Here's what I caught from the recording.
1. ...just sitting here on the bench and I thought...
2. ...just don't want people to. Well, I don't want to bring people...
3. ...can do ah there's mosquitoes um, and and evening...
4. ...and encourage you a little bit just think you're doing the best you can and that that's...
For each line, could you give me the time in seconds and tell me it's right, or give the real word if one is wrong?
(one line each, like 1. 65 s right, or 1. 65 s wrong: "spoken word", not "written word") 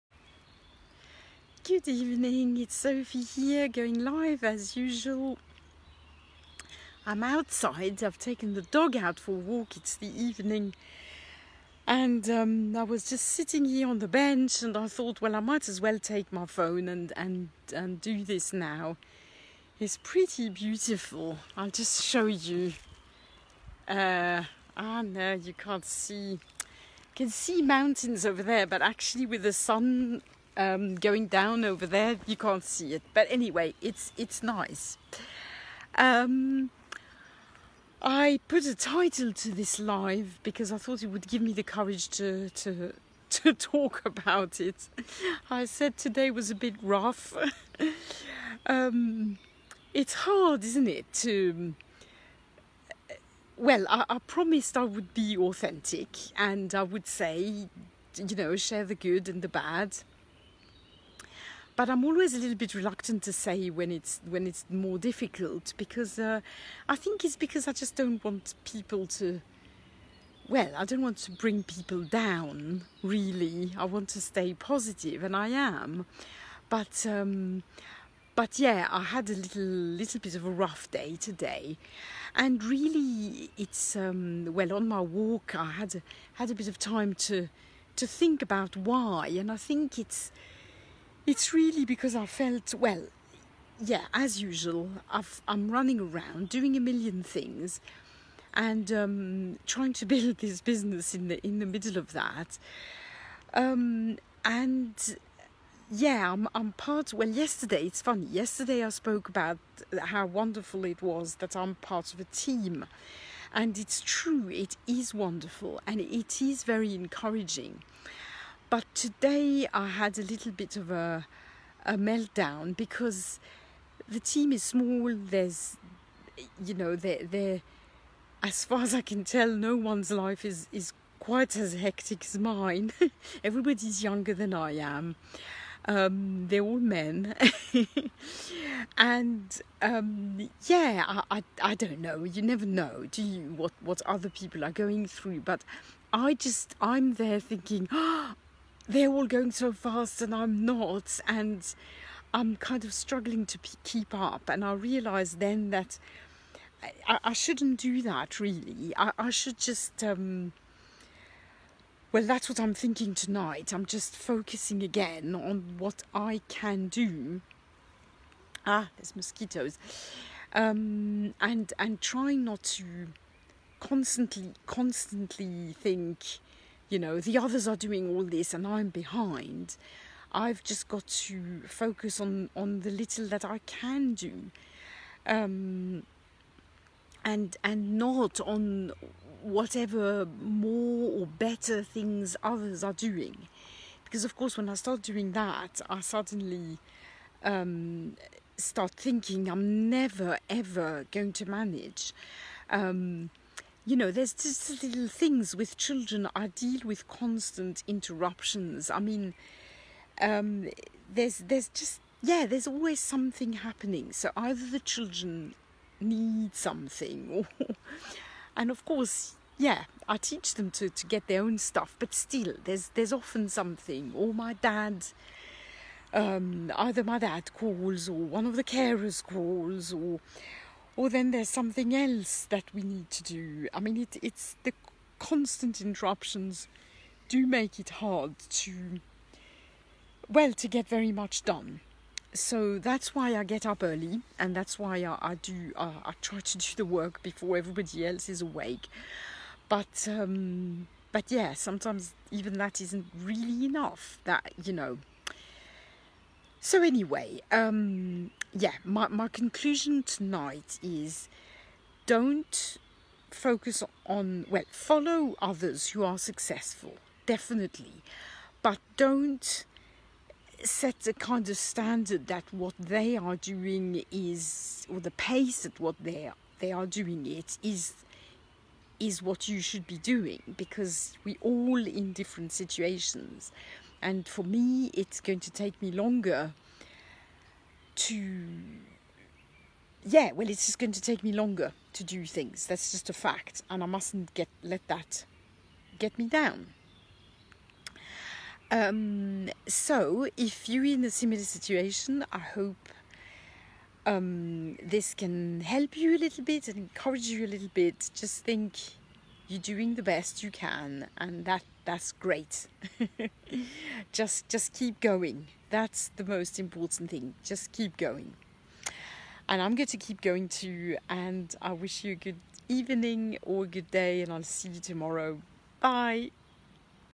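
1. 13 s right
2. 67 s right
3. 166 s wrong: "trying", not "evening"
4. 306 s right.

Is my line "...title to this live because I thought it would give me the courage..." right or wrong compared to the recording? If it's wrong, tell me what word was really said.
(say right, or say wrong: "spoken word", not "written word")
right.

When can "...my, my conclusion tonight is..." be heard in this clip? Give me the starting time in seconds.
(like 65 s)
258 s.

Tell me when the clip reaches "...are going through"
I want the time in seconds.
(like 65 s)
144 s.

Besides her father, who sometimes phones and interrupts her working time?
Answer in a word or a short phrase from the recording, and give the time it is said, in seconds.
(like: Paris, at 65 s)
The carers, at 228 s.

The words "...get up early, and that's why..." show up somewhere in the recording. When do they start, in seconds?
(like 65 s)
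243 s.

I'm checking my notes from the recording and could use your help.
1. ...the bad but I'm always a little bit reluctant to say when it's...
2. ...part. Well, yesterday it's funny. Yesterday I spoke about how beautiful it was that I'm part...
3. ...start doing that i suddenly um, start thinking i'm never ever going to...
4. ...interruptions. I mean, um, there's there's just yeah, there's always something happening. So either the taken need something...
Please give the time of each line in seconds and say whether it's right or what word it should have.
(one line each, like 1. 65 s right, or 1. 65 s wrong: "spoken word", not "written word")
1. 59 s right
2. 106 s wrong: "wonderful", not "beautiful"
3. 194 s right
4. 207 s wrong: "children", not "taken".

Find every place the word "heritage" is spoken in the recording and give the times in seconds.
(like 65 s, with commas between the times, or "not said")
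not said.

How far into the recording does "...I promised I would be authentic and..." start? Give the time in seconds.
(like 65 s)
54 s.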